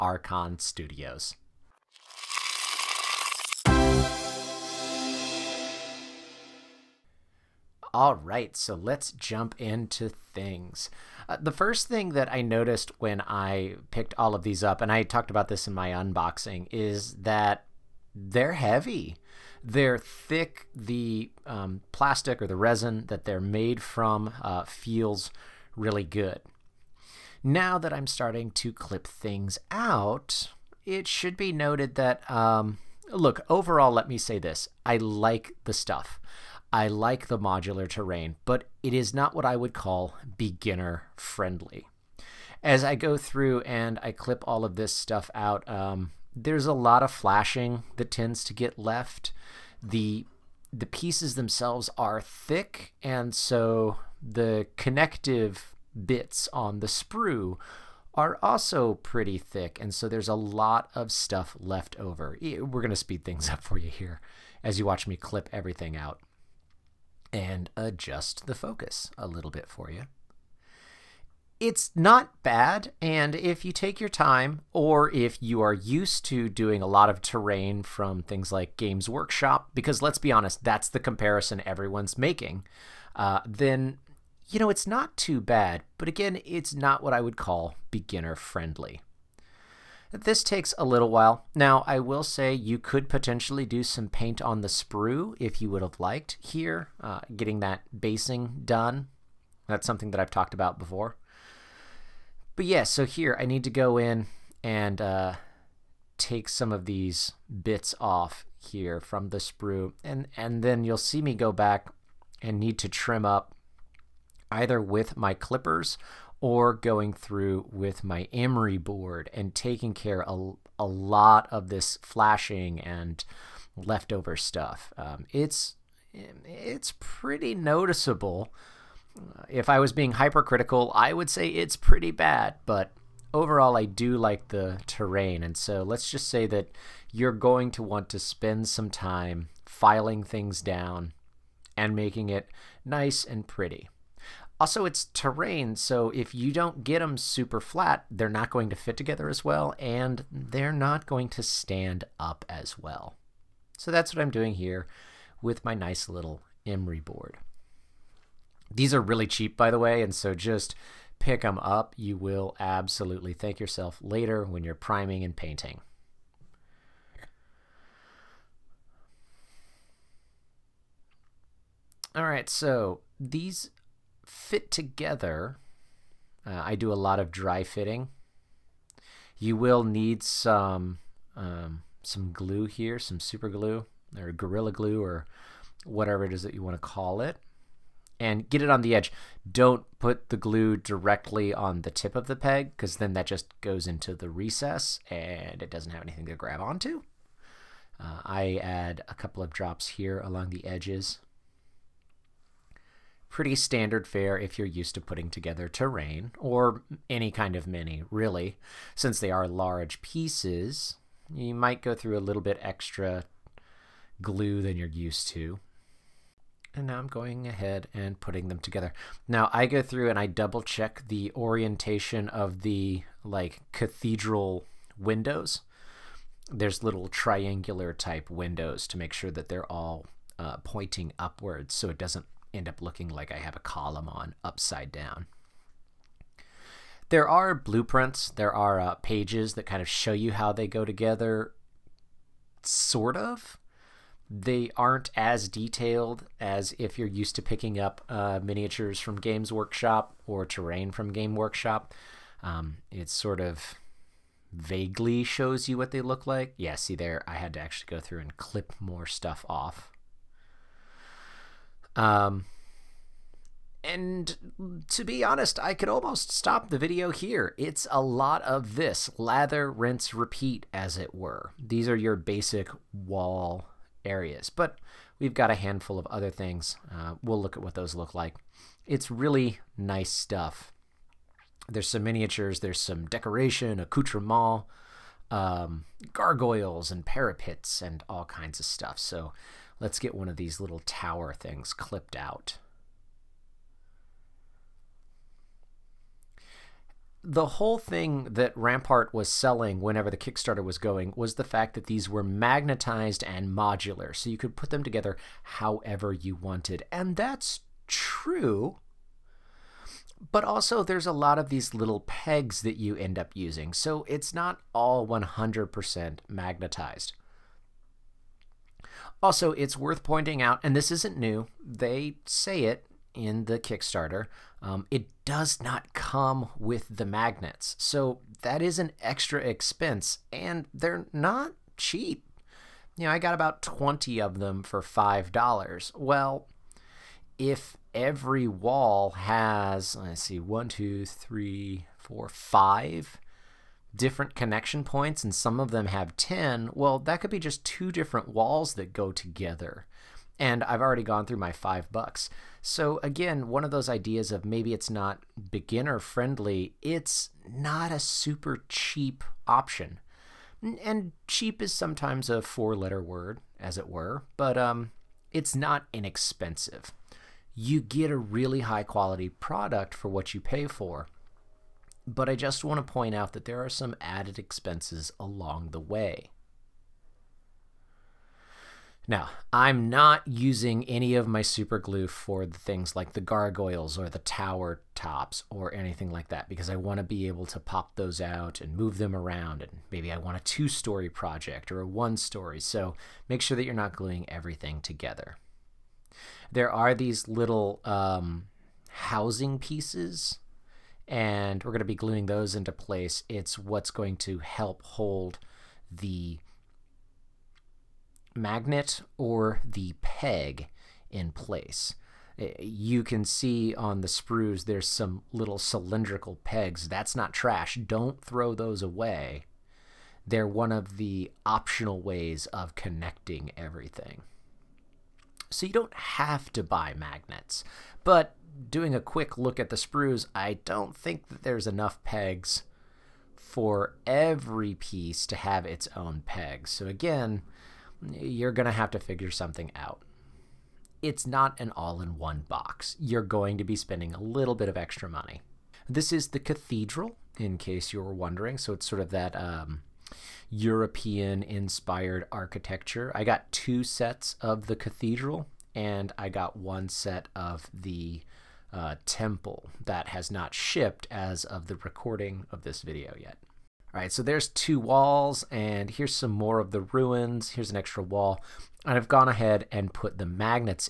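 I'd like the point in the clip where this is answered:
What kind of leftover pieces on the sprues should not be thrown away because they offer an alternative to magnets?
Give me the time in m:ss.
6:55.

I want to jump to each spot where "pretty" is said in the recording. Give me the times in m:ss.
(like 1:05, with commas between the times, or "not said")
0:58, 2:06, 2:11, 2:23, 3:23.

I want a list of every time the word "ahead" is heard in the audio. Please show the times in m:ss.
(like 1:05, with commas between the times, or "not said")
3:37, 7:49.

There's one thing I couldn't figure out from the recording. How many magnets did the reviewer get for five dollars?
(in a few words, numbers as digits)
20.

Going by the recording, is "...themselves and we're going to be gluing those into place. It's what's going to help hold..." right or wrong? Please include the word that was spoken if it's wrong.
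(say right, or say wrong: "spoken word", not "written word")
wrong: "pieces", not "themselves".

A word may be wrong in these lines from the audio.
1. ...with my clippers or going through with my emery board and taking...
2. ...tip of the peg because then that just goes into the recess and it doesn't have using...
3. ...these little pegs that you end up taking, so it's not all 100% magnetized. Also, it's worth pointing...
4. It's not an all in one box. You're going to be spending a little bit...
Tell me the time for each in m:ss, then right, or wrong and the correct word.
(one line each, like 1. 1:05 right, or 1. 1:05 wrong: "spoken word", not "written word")
1. 1:54 right
2. 3:11 wrong: "anything", not "using"
3. 5:11 wrong: "using", not "taking"
4. 7:21 right.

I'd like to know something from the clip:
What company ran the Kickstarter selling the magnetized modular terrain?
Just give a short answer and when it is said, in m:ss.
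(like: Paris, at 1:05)
Rampart, at 4:58.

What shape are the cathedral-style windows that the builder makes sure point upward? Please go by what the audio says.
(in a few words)
triangular.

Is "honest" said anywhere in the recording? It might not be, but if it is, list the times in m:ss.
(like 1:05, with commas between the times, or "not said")
1:20, 4:25.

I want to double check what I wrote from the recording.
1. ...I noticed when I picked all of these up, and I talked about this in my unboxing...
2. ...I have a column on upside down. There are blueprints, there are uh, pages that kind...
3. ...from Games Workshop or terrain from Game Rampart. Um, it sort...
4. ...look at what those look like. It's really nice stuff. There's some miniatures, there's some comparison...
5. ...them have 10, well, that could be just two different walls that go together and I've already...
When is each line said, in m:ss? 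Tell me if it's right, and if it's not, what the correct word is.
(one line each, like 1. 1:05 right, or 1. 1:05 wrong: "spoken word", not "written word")
1. 0:12 right
2. 3:53 right
3. 4:08 wrong: "Workshop", not "Rampart"
4. 4:37 wrong: "decoration", not "comparison"
5. 5:45 right.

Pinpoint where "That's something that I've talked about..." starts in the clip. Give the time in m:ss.
1:39.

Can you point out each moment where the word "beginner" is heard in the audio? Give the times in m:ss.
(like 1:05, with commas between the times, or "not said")
0:40, 1:27, 5:55.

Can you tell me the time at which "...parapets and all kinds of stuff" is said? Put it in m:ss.
4:47.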